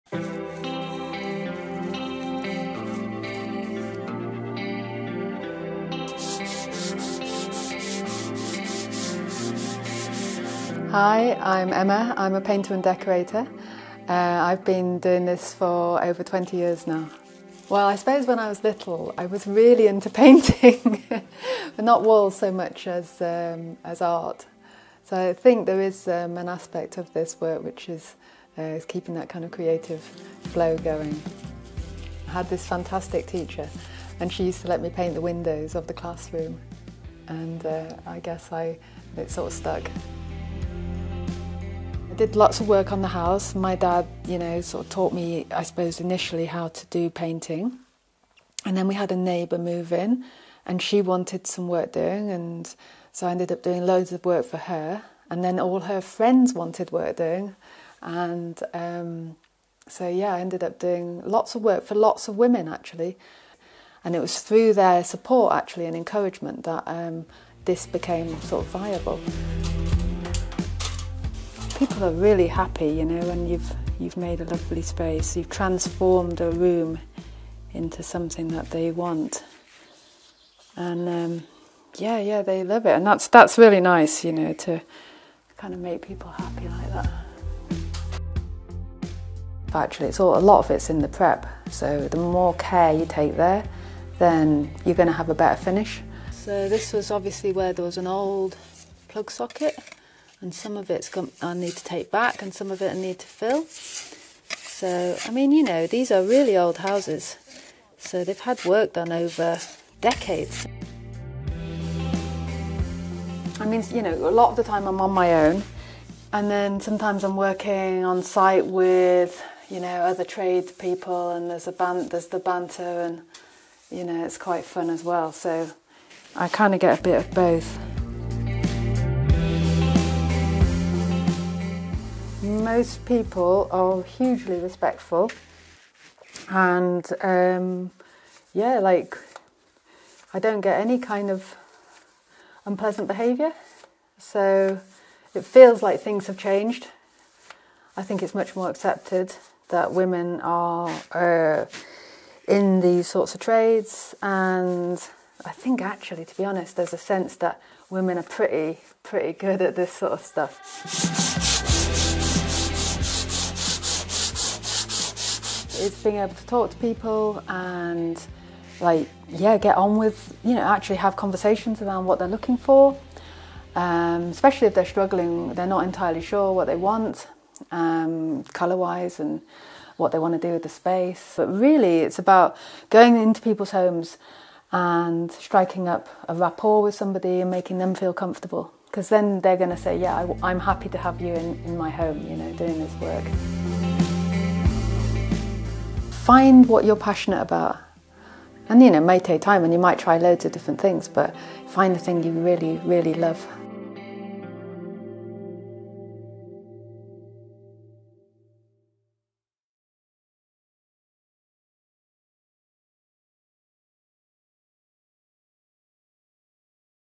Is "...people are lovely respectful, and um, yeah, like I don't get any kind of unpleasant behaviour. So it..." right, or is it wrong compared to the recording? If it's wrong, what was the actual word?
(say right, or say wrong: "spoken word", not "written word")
wrong: "hugely", not "lovely".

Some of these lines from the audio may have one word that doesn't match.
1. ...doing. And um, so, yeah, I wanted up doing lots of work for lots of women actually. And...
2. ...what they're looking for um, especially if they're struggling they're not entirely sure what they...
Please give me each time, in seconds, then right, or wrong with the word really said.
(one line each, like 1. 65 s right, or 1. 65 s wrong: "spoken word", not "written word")
1. 57 s wrong: "ended", not "wanted"
2. 172 s right.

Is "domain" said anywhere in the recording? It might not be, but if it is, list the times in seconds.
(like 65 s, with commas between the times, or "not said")
not said.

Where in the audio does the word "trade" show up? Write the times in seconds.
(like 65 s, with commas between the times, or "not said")
120 s, 153 s.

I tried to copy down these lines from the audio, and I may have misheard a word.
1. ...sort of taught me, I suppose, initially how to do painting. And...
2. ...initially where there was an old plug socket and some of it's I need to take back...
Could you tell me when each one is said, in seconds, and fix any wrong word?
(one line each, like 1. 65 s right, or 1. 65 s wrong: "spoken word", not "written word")
1. 44 s right
2. 97 s wrong: "obviously", not "initially".